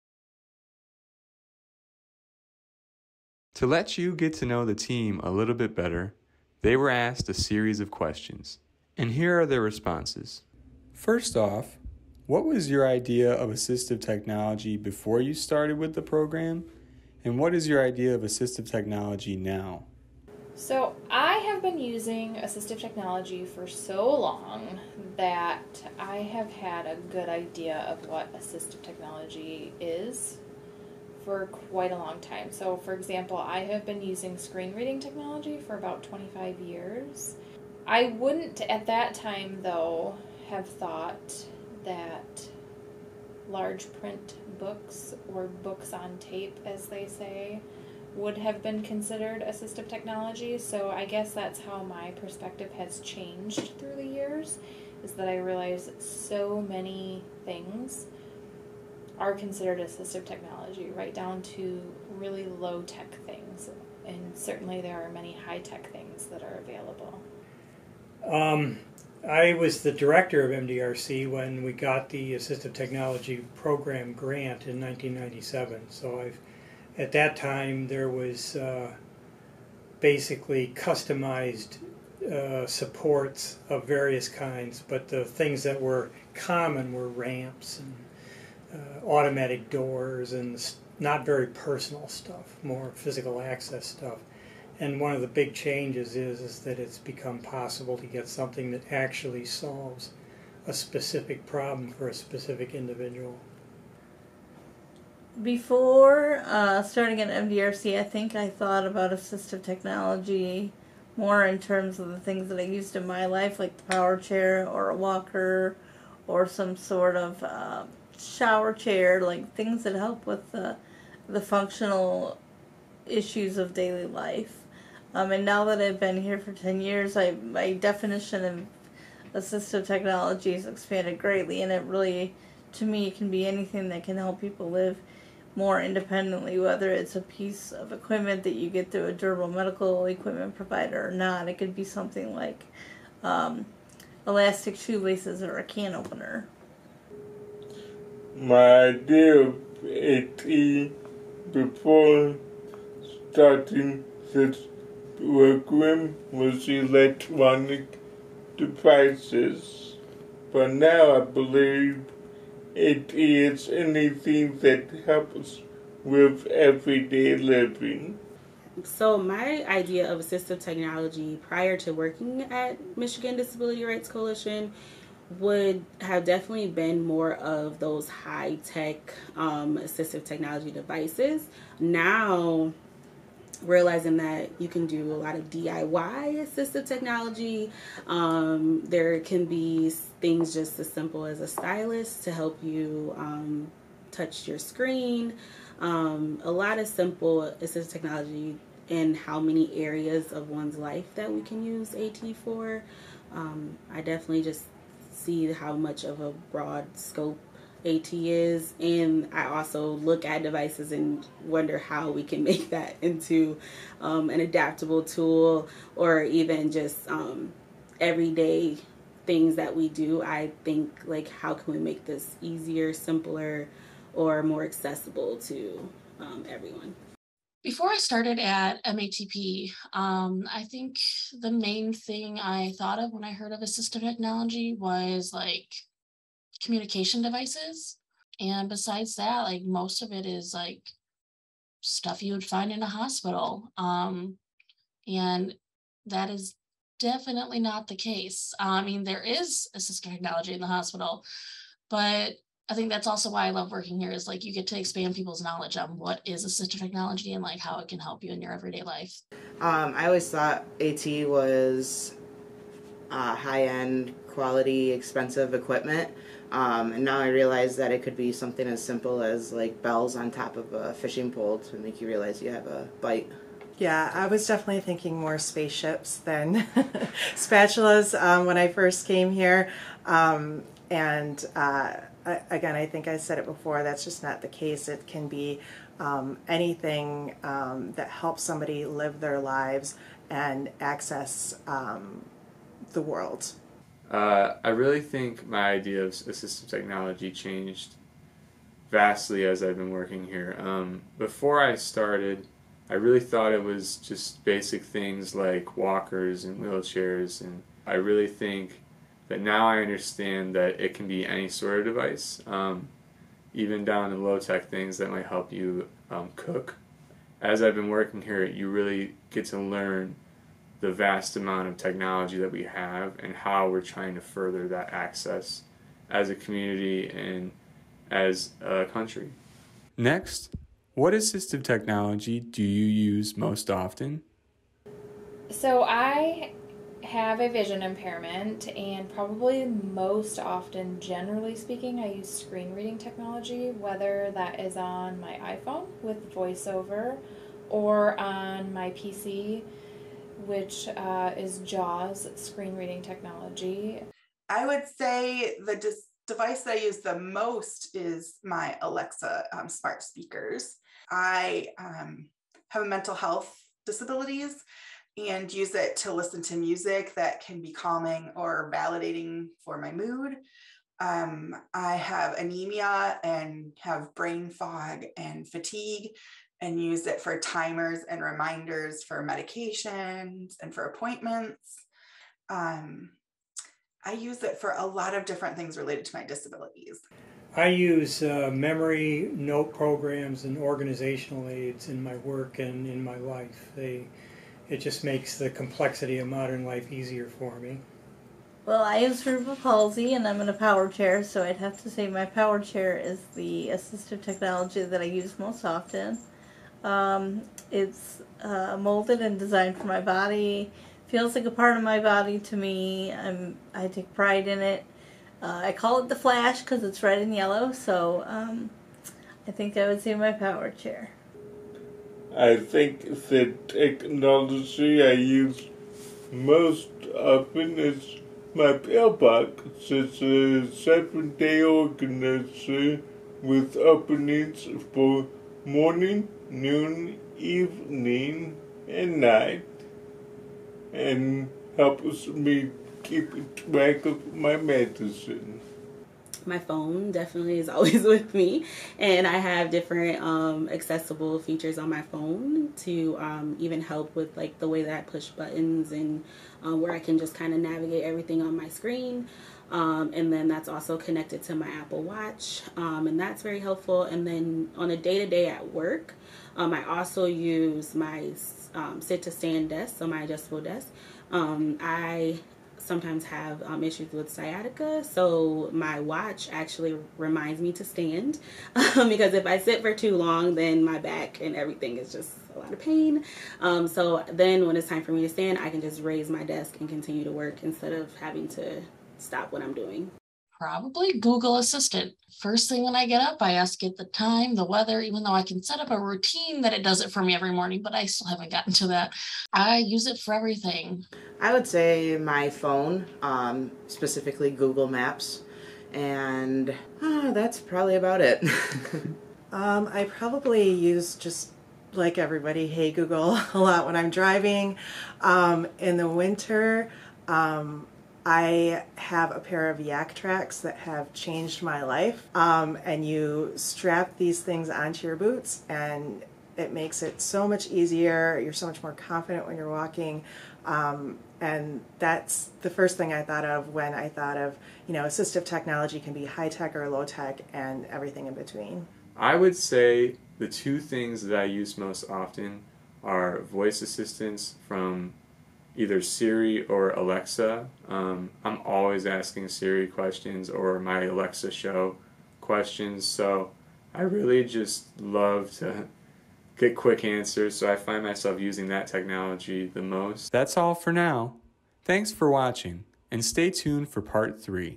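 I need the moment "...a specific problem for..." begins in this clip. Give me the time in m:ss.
1:40.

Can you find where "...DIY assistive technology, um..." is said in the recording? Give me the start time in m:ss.
3:05.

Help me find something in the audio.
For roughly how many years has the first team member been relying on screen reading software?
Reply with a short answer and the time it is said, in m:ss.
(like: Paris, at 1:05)
25 years, at 0:35.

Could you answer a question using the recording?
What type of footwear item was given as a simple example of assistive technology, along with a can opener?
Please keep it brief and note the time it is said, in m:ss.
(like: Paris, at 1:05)
Elastic shoelaces, at 2:24.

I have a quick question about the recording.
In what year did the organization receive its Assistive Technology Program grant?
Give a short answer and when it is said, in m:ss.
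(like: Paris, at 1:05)
1997, at 1:14.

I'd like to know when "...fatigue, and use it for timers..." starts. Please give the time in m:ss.
6:15.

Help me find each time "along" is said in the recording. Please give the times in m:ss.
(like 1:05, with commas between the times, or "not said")
not said.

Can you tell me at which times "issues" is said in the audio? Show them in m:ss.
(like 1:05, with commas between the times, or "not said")
2:03, 7:53.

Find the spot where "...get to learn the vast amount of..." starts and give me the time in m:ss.
5:19.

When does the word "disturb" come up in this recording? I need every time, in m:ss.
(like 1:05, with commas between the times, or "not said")
not said.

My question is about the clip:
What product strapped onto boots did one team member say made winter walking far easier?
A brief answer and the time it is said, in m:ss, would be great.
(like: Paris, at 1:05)
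Yaktrax, at 8:39.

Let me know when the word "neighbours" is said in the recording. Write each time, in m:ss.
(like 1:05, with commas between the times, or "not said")
not said.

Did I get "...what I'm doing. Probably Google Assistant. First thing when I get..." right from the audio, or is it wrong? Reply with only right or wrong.
right.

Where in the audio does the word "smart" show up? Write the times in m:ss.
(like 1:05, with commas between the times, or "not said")
5:59.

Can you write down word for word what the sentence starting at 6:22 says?
Um, I use it for a lot of different things related to my disabilities.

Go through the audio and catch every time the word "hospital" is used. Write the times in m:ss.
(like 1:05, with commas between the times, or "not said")
4:02, 4:10.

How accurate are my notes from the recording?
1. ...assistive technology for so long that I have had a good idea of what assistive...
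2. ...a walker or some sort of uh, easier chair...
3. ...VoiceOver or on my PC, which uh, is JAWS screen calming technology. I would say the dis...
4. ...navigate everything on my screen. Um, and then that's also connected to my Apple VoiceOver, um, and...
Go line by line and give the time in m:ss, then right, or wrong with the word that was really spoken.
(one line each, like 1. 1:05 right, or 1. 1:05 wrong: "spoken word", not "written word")
1. 0:22 right
2. 1:54 wrong: "shower", not "easier"
3. 5:46 wrong: "reading", not "calming"
4. 7:37 wrong: "Watch", not "VoiceOver".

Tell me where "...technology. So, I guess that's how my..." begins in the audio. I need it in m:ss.
0:49.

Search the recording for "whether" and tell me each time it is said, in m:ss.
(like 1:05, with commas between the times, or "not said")
2:16, 5:43.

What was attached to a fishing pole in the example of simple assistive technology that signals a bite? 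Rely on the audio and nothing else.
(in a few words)
Bells.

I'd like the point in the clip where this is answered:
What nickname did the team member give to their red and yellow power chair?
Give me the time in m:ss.
6:56.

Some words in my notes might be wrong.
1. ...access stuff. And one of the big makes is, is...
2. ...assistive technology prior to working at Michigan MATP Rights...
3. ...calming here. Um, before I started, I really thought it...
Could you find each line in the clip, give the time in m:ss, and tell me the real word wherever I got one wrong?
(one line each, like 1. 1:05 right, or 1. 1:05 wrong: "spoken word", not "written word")
1. 1:33 wrong: "changes", not "makes"
2. 2:50 wrong: "Disability", not "MATP"
3. 4:59 wrong: "working", not "calming".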